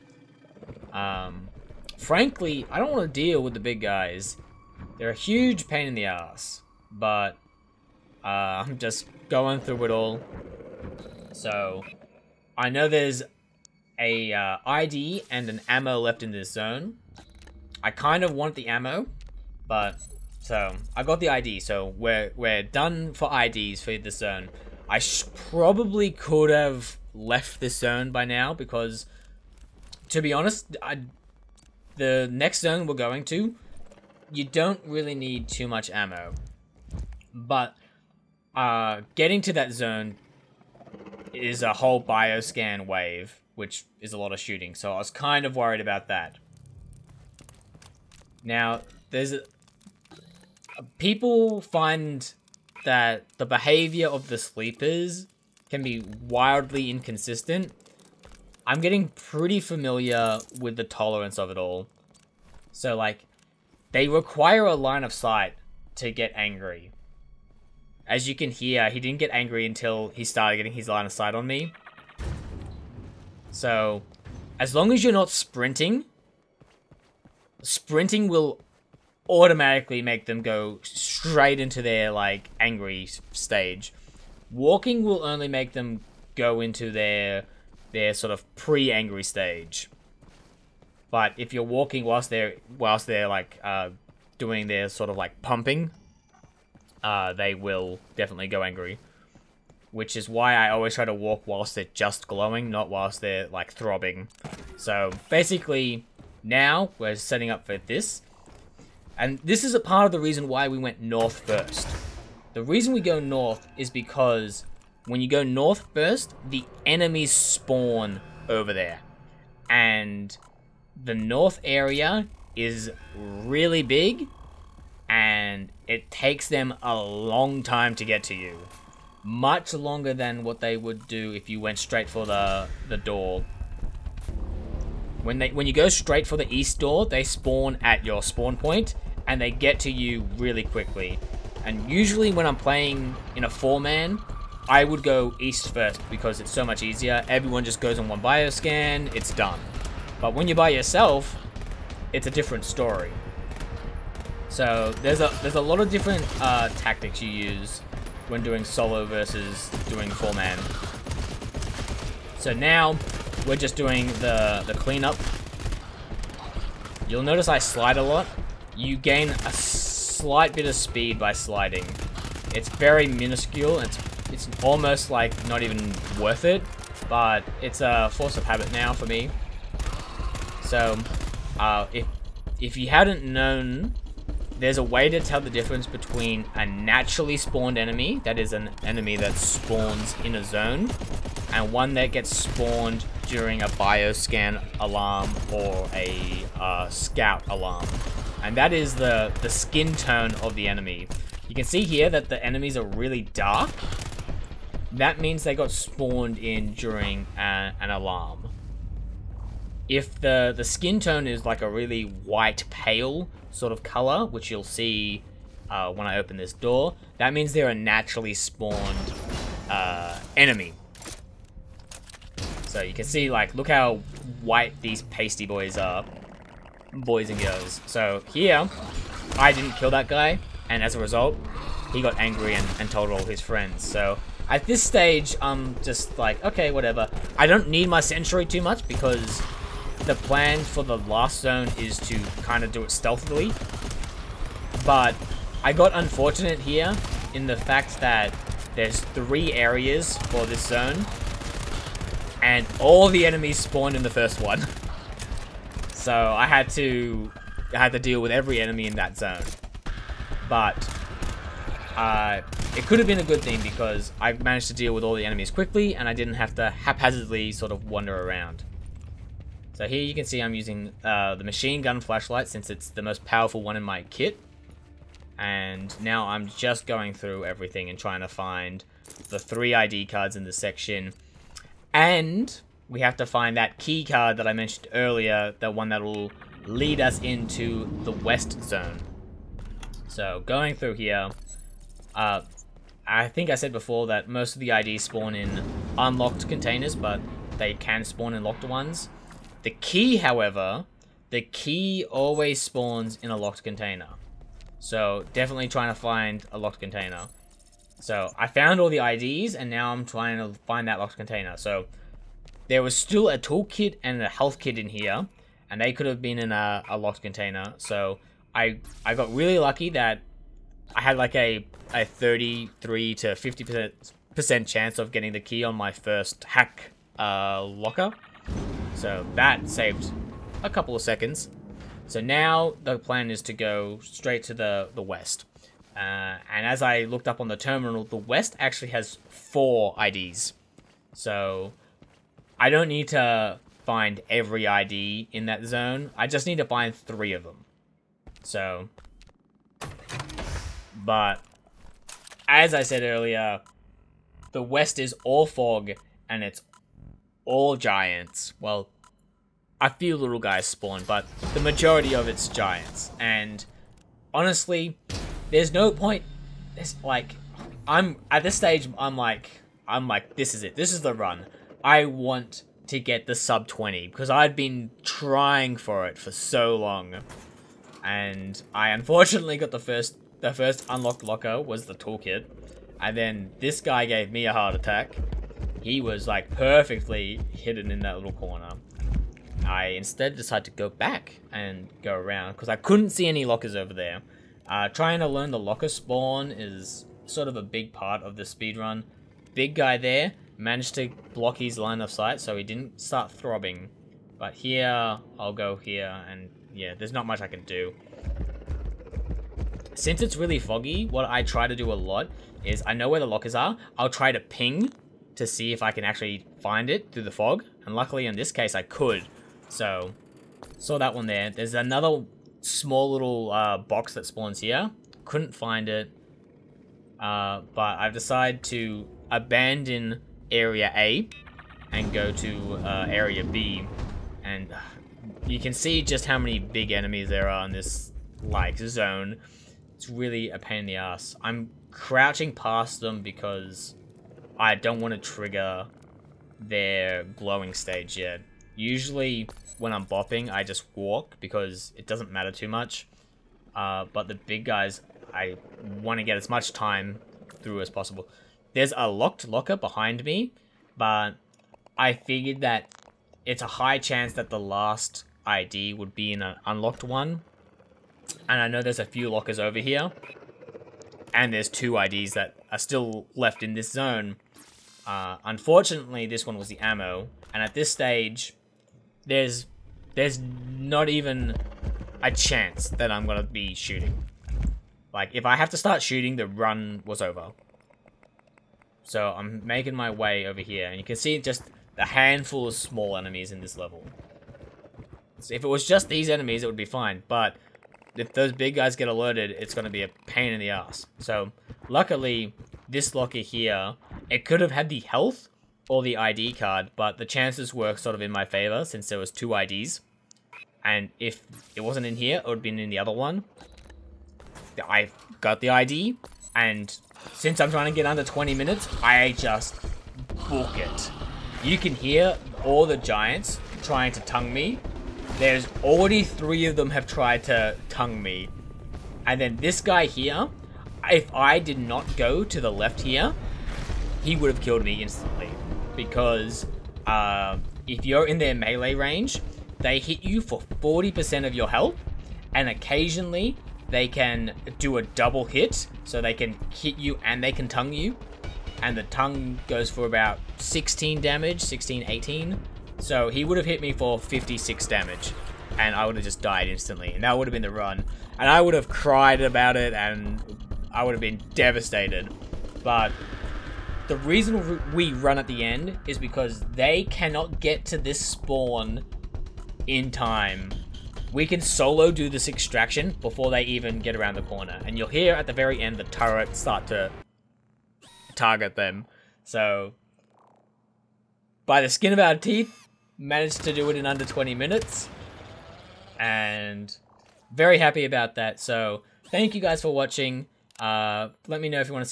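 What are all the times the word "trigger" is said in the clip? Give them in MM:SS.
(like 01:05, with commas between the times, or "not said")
07:25.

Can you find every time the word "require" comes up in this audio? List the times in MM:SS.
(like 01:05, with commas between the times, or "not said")
01:04.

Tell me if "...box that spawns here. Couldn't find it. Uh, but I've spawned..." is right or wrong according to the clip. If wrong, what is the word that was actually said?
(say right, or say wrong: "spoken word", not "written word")
wrong: "decided", not "spawned".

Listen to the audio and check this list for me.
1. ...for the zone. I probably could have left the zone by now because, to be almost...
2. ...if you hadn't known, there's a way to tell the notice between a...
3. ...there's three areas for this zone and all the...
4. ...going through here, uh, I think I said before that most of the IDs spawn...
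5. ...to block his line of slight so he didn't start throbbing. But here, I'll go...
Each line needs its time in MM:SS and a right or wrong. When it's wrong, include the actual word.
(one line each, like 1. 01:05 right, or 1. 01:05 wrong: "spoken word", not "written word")
1. 00:23 wrong: "honest", not "almost"
2. 03:02 wrong: "difference", not "notice"
3. 04:08 right
4. 04:50 right
5. 06:40 wrong: "sight", not "slight".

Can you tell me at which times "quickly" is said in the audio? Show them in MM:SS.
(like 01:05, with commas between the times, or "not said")
02:20, 04:25.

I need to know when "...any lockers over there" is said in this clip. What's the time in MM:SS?
06:33.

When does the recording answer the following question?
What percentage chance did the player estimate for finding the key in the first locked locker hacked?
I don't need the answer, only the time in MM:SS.
05:22.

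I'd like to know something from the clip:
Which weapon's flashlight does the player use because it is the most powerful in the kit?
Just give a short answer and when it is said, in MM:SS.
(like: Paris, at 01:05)
Machine gun, at 04:31.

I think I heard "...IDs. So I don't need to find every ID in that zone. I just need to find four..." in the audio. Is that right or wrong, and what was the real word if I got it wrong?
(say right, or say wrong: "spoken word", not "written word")
wrong: "three", not "four".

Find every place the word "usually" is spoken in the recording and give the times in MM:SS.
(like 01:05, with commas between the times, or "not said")
02:21, 07:28.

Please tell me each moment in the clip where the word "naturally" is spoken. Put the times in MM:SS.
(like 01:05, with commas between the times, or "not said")
03:06, 03:37.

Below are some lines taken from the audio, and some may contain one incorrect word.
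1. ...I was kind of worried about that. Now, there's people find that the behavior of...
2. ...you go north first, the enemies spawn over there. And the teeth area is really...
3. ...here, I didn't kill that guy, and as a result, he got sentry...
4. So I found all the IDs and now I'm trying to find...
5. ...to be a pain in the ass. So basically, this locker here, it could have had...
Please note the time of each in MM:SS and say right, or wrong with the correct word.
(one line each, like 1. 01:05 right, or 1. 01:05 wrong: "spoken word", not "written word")
1. 00:44 right
2. 01:55 wrong: "north", not "teeth"
3. 03:48 wrong: "angry", not "sentry"
4. 05:08 right
5. 08:19 wrong: "luckily", not "basically".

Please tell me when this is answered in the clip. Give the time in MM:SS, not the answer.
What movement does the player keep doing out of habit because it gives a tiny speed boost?
02:51.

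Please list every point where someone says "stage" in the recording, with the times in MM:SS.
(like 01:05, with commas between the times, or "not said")
01:23, 01:29, 03:54, 06:08, 07:27, 07:57.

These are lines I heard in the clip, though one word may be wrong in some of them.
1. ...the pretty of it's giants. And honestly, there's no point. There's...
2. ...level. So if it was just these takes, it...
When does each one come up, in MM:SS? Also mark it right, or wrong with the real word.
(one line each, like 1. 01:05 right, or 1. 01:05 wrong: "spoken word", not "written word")
1. 06:01 wrong: "majority", not "pretty"
2. 08:13 wrong: "enemies", not "takes".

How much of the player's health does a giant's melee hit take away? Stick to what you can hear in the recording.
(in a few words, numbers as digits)
40%.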